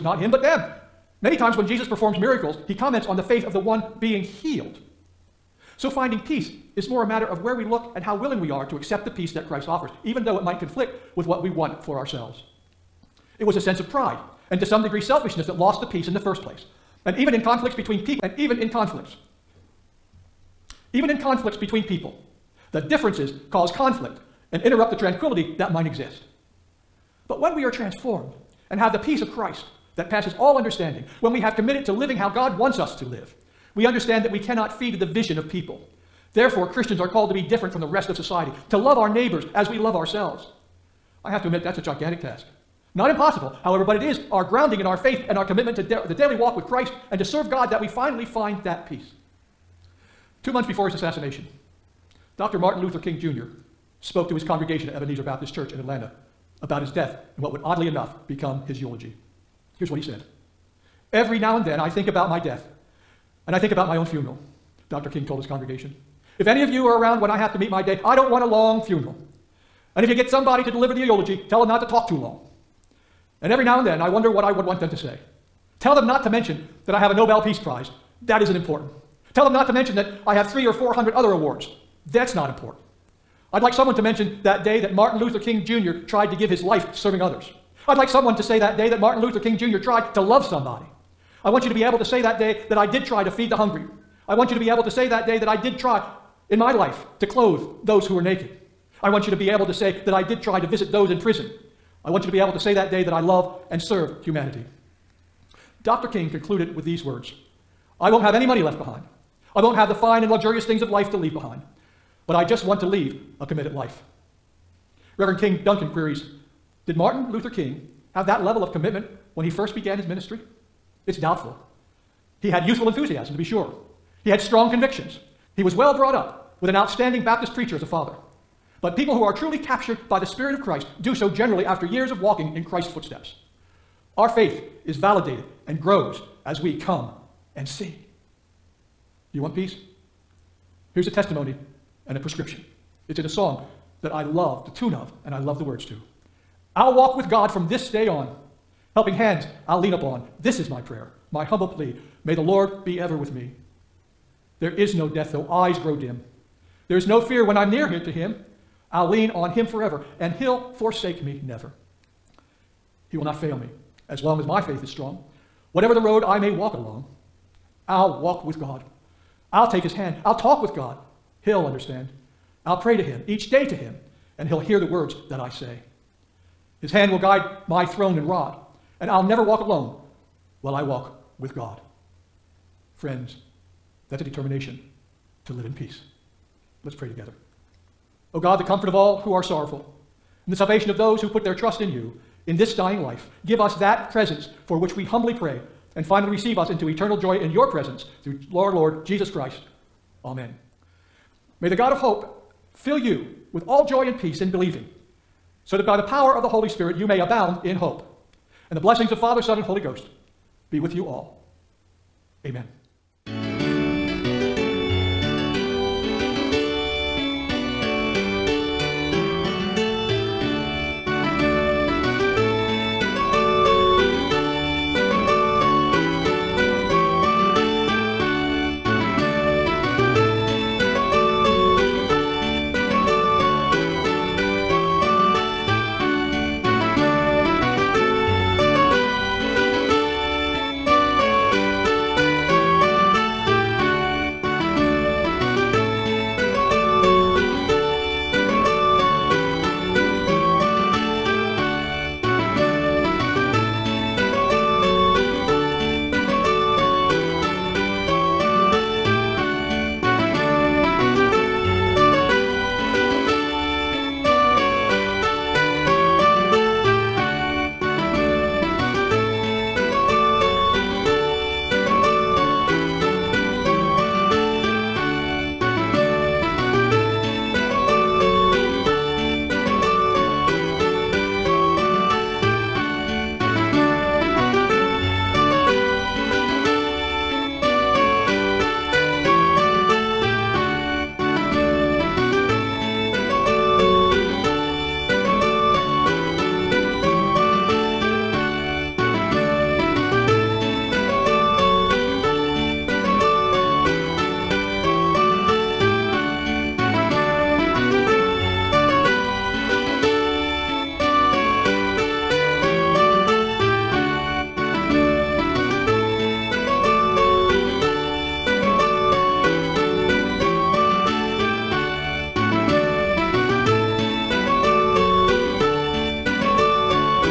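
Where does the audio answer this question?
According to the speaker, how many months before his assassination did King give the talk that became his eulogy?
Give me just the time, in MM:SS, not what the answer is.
00:50.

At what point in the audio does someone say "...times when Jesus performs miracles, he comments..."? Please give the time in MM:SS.
00:01.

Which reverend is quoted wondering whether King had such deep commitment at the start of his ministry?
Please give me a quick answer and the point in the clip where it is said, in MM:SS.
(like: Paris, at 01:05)
King Duncan, at 01:55.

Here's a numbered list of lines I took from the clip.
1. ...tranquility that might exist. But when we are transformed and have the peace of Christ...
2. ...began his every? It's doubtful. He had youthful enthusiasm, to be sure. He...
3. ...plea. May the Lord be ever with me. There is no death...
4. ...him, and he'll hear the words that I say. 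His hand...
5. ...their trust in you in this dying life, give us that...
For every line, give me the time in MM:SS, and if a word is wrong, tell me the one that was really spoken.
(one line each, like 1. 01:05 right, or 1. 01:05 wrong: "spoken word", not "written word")
1. 00:24 right
2. 01:59 wrong: "ministry", not "every"
3. 02:31 right
4. 02:53 right
5. 03:11 right.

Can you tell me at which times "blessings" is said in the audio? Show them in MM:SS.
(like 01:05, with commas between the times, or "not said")
03:28.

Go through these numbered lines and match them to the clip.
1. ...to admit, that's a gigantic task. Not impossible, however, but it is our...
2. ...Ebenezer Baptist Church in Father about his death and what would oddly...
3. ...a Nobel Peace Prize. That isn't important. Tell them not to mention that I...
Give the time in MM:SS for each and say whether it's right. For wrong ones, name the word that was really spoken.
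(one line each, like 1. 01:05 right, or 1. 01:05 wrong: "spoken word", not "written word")
1. 00:41 right
2. 00:54 wrong: "Atlanta", not "Father"
3. 01:17 right.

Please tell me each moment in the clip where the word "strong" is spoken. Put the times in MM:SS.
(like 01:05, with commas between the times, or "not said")
02:04, 02:44.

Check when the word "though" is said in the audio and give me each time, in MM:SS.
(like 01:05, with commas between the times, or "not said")
00:10, 02:35.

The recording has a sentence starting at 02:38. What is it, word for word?
I'll lean on him forever, and he'll forsake me never.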